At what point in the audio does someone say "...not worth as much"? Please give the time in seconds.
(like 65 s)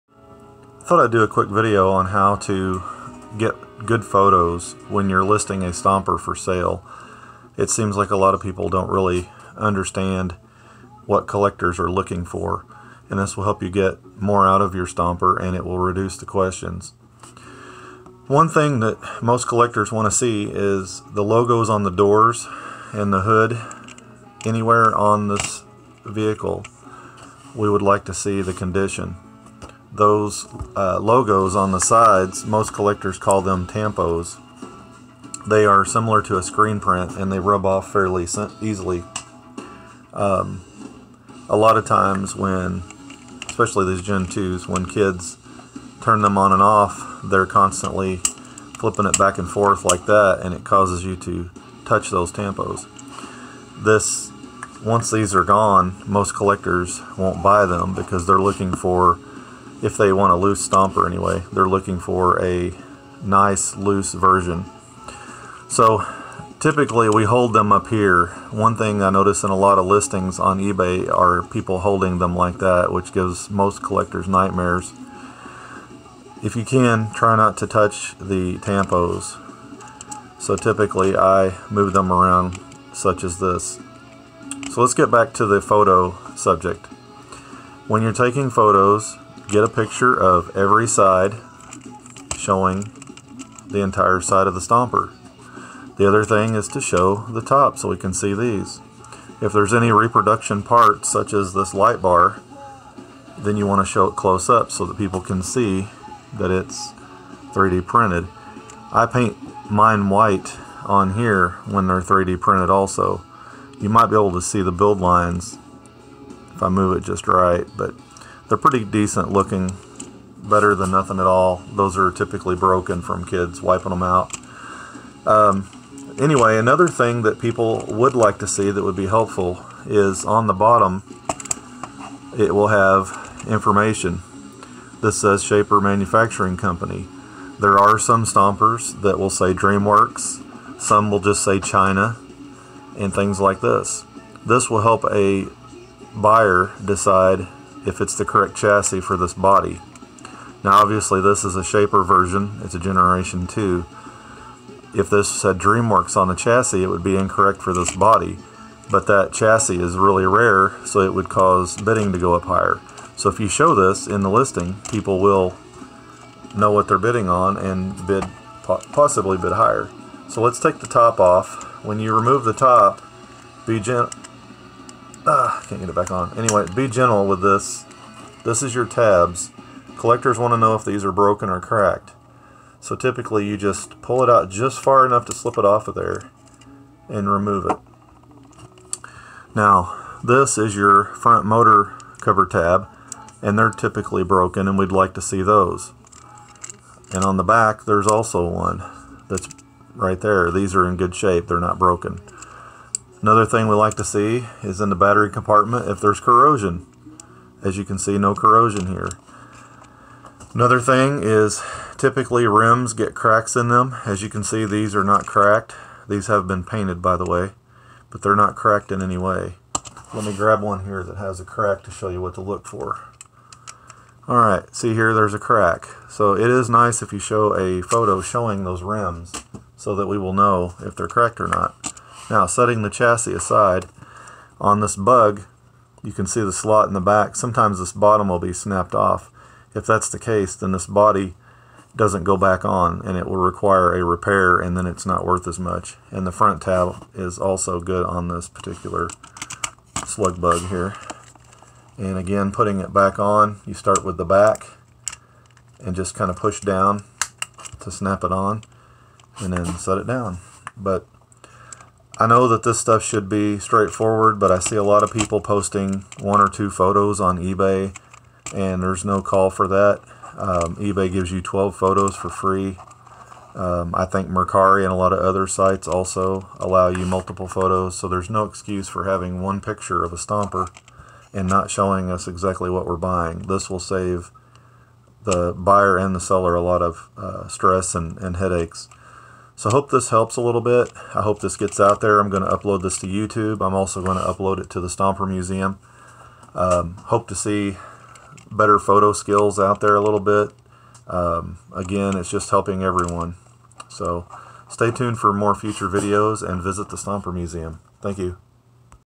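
245 s.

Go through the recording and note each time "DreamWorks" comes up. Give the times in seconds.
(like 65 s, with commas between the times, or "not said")
139 s, 155 s.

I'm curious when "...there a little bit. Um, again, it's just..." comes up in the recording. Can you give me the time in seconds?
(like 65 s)
299 s.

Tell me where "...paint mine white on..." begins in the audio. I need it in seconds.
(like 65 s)
109 s.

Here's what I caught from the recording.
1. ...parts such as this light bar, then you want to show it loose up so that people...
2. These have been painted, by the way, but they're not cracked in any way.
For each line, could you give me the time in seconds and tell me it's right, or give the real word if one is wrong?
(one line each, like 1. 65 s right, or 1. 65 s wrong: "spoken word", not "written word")
1. 100 s wrong: "close", not "loose"
2. 216 s right.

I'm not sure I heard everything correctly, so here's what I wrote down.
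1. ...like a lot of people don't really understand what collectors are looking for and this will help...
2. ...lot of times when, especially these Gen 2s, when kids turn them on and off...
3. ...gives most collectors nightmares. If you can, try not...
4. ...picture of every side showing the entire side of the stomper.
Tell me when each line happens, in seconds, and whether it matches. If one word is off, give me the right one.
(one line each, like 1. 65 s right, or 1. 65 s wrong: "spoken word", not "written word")
1. 7 s right
2. 41 s right
3. 73 s right
4. 89 s right.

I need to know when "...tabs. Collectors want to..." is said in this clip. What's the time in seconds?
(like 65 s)
178 s.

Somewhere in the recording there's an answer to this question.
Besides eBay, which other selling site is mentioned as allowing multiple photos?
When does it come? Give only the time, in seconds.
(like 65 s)
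274 s.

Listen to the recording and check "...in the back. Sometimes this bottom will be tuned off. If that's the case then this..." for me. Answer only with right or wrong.
wrong.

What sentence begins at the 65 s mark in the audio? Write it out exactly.
So typically we hold them up here.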